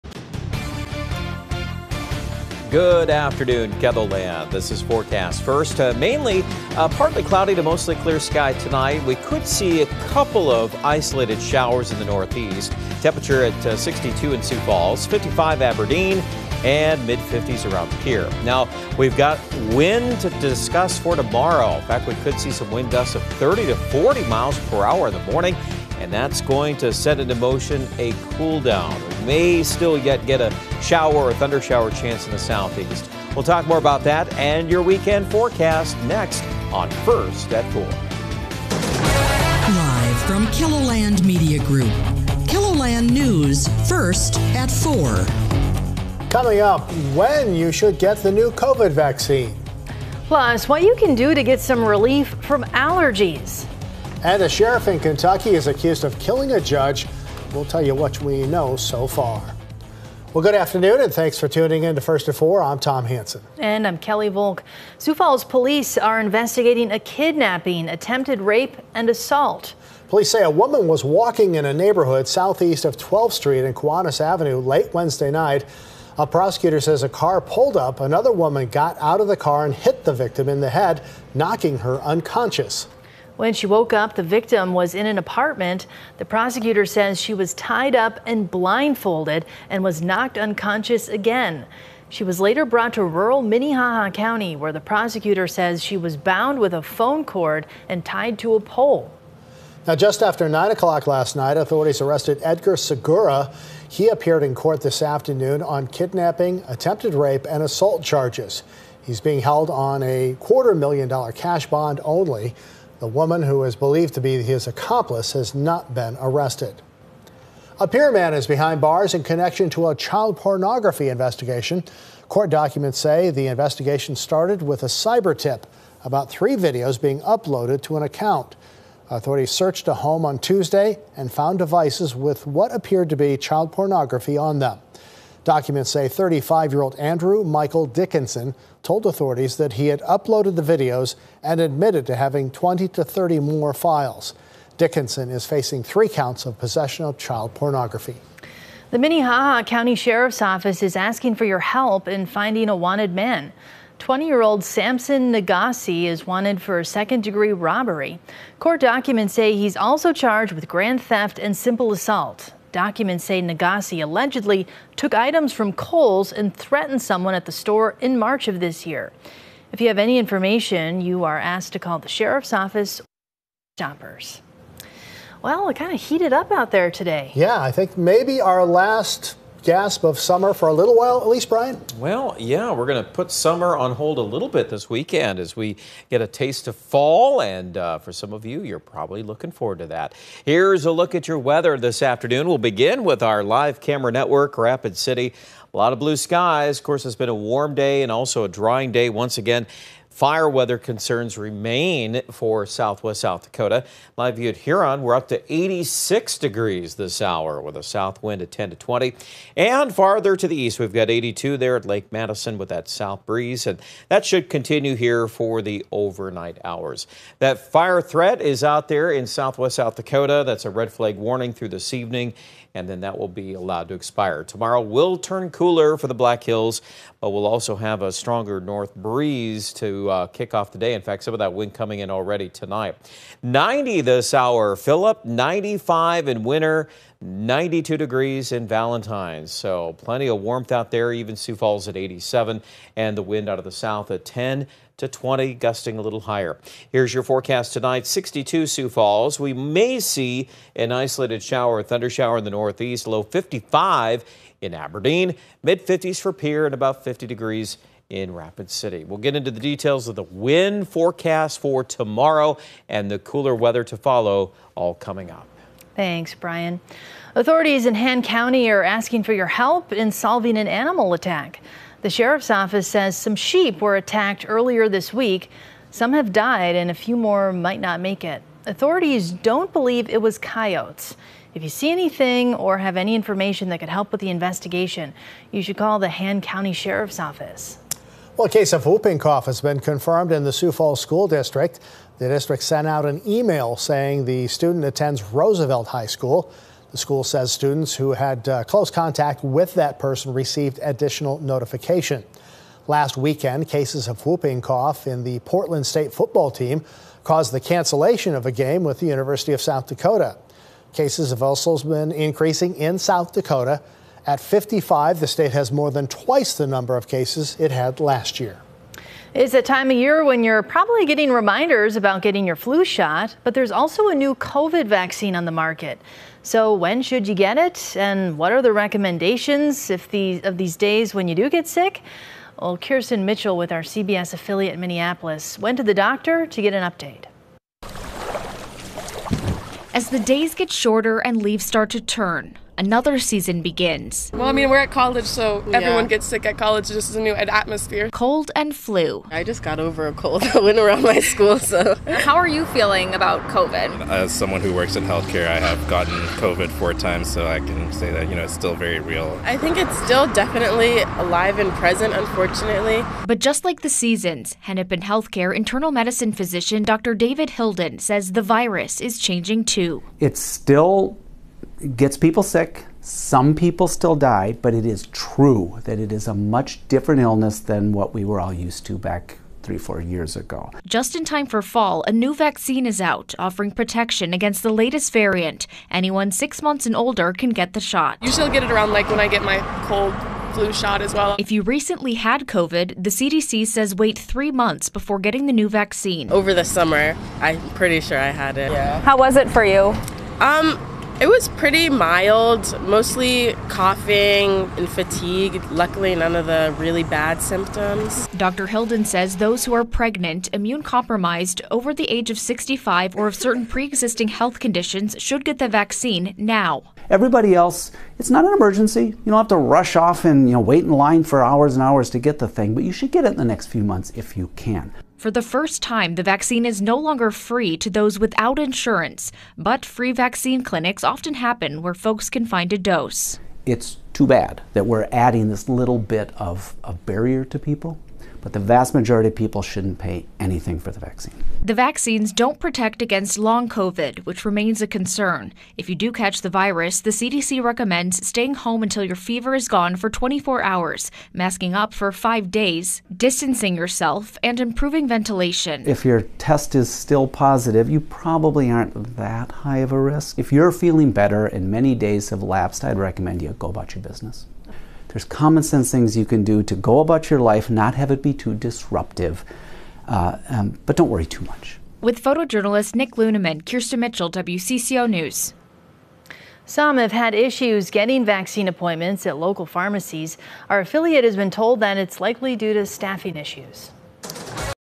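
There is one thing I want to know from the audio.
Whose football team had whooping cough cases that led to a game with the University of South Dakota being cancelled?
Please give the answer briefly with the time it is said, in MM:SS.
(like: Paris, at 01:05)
Portland State, at 05:05.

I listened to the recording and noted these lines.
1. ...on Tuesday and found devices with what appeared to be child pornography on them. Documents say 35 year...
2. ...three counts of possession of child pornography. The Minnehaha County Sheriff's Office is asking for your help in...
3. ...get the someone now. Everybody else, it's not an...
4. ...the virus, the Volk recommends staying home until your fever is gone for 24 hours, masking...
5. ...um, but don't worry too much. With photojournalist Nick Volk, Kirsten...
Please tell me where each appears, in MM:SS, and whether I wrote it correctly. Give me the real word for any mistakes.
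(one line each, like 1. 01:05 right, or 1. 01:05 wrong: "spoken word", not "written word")
1. 02:10 right
2. 02:25 right
3. 06:55 wrong: "vaccine", not "someone"
4. 07:26 wrong: "CDC", not "Volk"
5. 07:50 wrong: "Luneman", not "Volk".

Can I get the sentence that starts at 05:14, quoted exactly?
At 55, the state has more than twice the number of cases it had last year.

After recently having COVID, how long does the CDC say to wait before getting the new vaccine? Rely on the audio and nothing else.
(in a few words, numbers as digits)
3 months.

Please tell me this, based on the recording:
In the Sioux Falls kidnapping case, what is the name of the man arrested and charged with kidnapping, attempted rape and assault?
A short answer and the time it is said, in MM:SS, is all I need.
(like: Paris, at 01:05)
Edgar Segura, at 01:42.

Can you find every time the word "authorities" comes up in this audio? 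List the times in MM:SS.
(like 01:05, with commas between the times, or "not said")
01:41, 02:09, 02:19, 04:27, 04:38.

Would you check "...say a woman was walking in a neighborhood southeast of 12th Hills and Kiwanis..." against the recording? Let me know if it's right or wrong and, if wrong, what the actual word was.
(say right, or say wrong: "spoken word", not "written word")
wrong: "Street", not "Hills".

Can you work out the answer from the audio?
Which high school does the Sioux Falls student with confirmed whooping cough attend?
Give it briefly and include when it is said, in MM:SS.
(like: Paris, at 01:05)
Roosevelt High School, at 04:55.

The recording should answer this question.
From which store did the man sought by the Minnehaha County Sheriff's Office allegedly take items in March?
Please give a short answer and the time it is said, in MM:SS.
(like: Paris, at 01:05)
Kohl's, at 02:45.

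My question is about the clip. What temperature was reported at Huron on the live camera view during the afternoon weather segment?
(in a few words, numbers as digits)
86 degrees.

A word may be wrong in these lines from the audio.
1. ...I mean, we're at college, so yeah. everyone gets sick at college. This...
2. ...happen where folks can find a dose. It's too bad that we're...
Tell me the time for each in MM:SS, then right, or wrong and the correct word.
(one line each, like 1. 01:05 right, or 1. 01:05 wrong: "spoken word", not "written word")
1. 05:44 right
2. 07:11 right.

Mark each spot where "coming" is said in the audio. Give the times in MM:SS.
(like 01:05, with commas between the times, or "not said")
00:46, 03:51, 04:24.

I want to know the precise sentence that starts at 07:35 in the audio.
If your test is still positive, you probably aren't that high of a risk.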